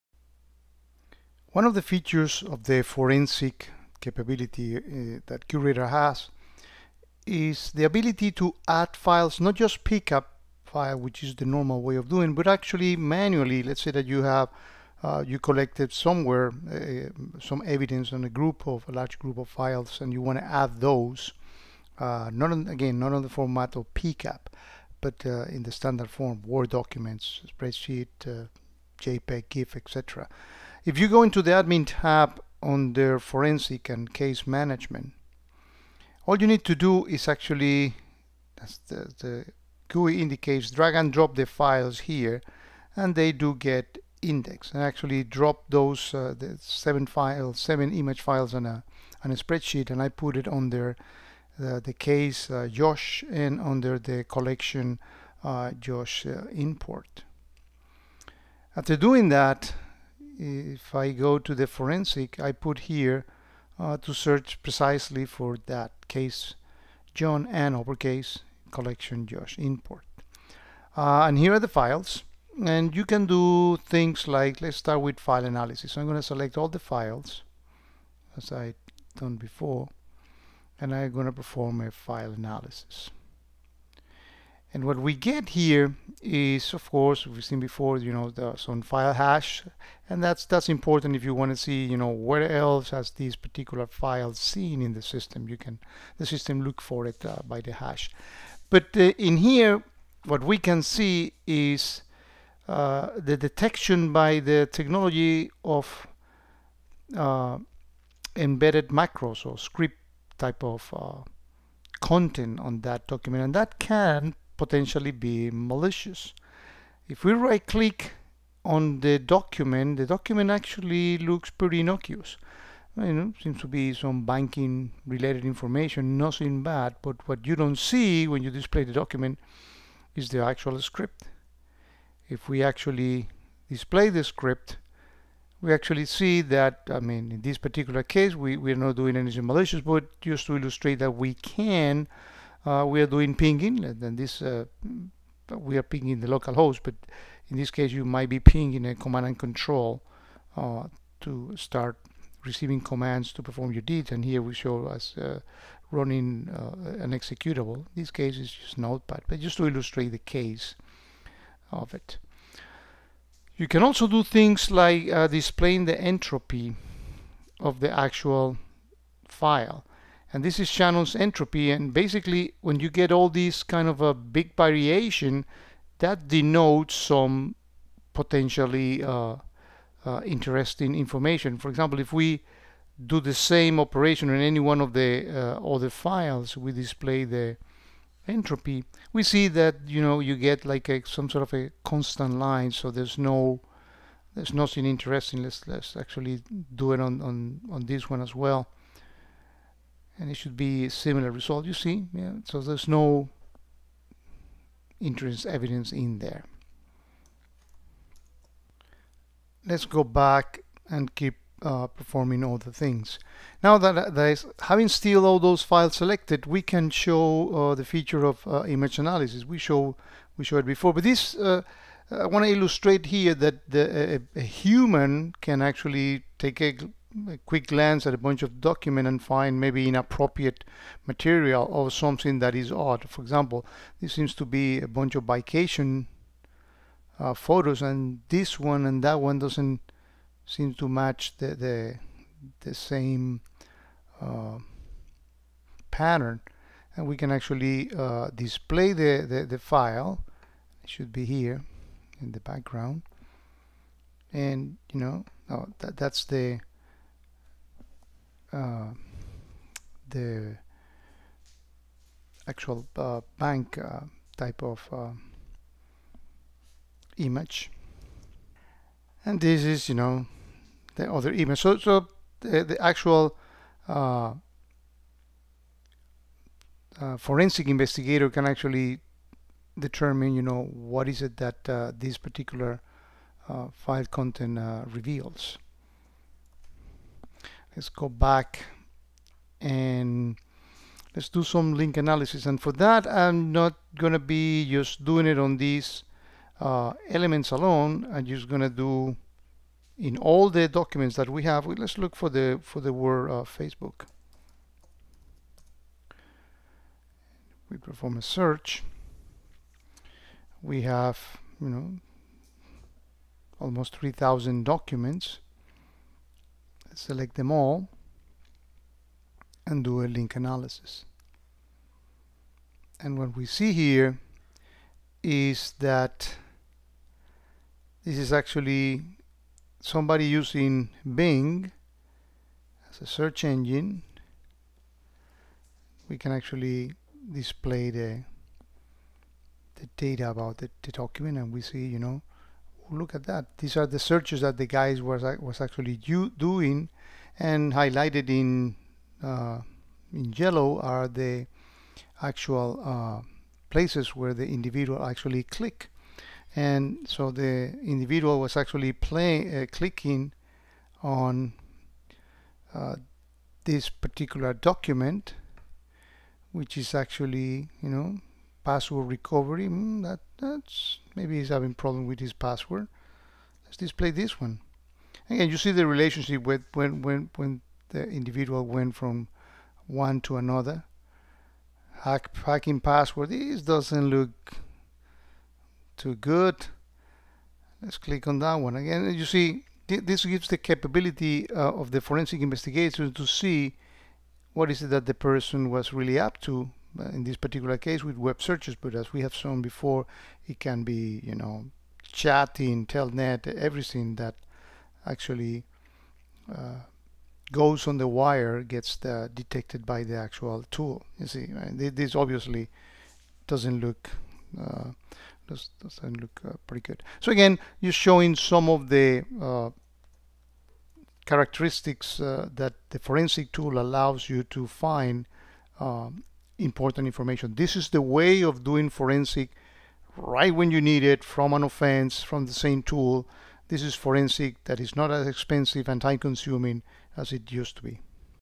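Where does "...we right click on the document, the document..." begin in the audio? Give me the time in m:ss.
1:57.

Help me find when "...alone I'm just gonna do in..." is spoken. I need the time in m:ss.
4:57.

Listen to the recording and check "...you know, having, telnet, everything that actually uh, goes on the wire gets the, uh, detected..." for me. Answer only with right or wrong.
wrong.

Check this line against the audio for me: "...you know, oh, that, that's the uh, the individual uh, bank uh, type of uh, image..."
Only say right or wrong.
wrong.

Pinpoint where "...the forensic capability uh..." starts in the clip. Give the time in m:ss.
0:02.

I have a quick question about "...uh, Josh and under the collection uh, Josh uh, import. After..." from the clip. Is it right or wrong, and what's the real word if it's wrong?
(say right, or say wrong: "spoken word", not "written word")
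right.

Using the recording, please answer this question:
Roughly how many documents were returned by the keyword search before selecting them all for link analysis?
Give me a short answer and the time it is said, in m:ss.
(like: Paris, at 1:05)
3,000, at 5:13.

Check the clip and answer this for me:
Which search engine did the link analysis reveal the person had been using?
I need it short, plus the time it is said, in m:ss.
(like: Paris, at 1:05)
Bing, at 5:31.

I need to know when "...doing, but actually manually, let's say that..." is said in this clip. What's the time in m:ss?
0:12.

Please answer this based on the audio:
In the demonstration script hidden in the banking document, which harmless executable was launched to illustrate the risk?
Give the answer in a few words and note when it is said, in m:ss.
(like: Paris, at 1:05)
notepad, at 2:38.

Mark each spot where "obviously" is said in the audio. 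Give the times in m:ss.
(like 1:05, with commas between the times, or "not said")
6:52.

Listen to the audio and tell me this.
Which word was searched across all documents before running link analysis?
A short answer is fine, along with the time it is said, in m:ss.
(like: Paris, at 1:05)
Facebook, at 5:03.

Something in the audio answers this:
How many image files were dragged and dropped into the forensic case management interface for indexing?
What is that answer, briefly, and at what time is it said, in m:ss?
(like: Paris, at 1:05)
7, at 0:47.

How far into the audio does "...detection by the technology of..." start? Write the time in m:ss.
1:43.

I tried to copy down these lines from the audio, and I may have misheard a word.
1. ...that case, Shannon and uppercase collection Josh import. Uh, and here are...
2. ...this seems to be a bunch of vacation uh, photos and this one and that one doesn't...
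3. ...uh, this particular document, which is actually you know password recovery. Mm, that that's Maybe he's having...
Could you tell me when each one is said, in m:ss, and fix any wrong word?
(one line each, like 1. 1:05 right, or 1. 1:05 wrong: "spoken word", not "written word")
1. 1:05 wrong: "John", not "Shannon"
2. 3:53 right
3. 6:02 right.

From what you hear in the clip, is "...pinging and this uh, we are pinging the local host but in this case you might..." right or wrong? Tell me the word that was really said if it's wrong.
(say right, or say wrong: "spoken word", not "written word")
right.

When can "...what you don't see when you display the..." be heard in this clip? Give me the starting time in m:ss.
2:07.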